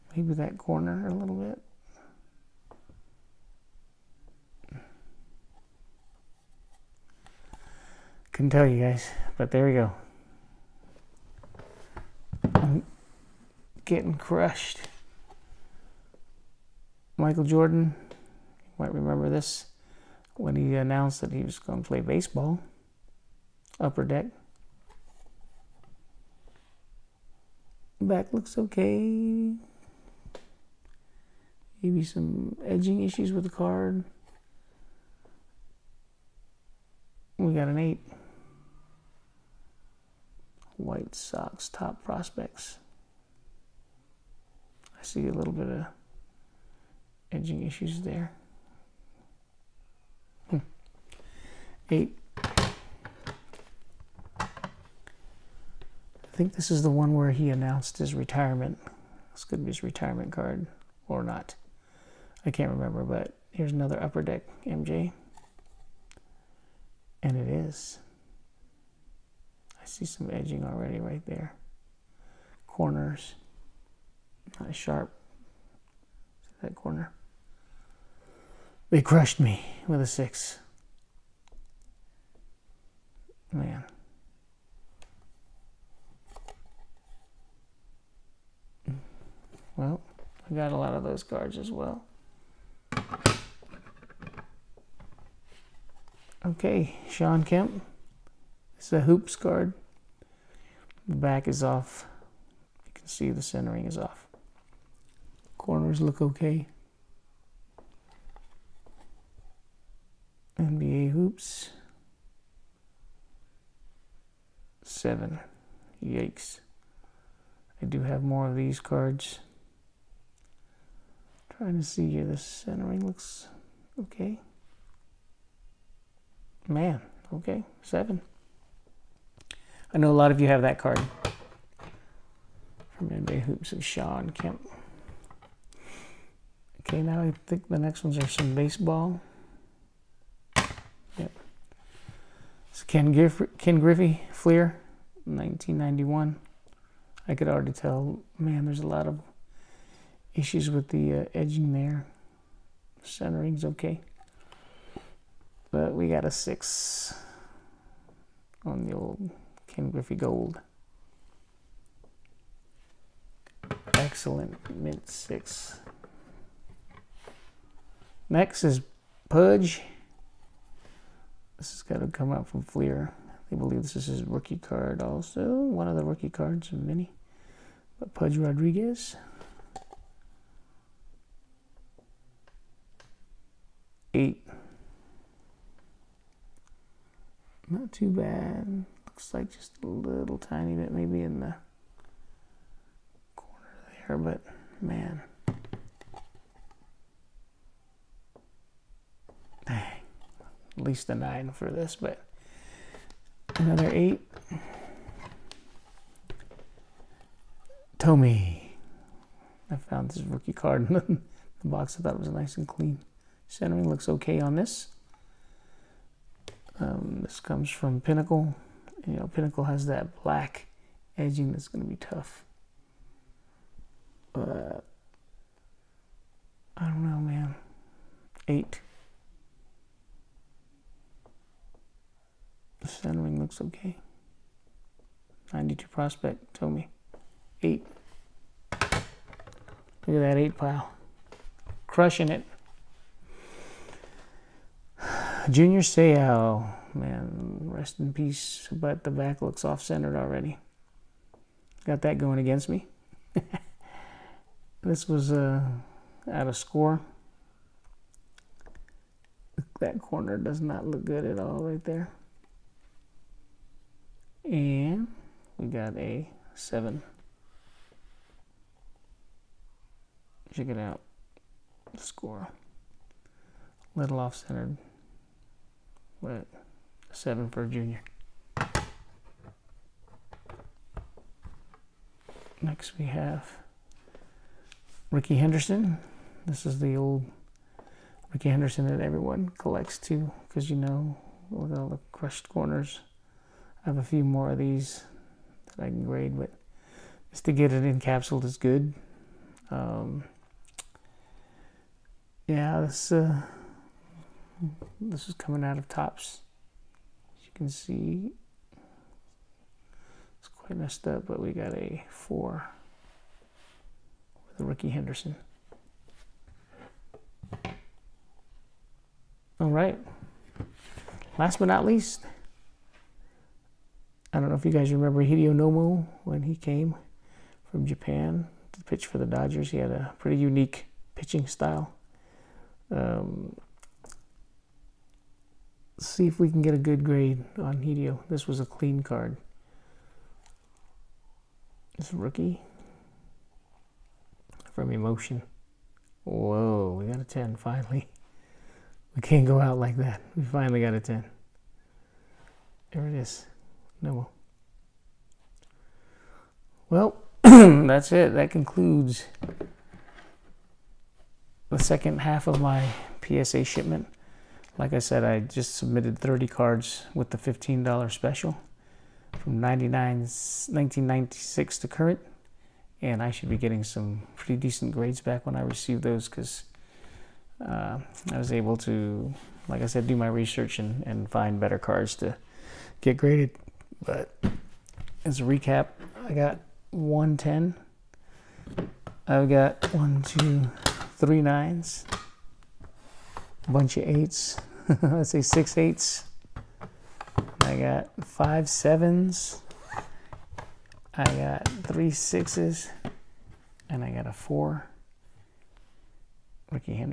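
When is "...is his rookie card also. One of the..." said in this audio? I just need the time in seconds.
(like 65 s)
173 s.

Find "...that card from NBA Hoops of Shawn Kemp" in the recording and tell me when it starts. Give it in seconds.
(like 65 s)
130 s.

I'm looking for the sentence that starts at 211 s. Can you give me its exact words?
I thought it was nice and clean.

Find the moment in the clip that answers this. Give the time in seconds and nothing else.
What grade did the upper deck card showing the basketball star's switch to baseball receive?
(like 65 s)
37 s.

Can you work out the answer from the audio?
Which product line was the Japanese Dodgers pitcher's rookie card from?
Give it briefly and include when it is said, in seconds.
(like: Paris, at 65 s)
Emotion, at 344 s.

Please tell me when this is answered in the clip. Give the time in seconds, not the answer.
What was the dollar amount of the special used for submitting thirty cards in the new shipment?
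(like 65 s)
367 s.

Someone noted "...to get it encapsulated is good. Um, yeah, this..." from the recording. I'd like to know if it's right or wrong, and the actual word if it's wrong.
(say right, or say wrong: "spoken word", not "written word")
right.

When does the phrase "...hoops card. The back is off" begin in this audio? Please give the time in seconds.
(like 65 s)
98 s.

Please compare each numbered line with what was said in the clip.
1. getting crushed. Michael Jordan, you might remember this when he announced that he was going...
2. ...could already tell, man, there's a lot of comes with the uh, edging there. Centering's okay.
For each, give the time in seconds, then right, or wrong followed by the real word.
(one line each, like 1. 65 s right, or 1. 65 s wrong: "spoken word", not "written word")
1. 13 s right
2. 147 s wrong: "issues", not "comes".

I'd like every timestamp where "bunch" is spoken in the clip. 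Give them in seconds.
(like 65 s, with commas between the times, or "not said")
393 s.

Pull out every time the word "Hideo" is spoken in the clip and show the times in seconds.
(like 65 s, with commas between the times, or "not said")
325 s, 337 s.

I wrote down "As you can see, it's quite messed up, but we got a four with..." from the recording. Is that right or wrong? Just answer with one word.
right.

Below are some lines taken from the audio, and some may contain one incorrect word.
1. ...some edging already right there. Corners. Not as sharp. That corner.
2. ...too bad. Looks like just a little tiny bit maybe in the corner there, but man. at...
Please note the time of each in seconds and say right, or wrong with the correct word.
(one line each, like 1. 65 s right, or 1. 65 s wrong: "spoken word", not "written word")
1. 70 s right
2. 187 s right.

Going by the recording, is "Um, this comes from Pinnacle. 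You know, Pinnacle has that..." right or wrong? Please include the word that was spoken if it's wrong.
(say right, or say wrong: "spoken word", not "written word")
right.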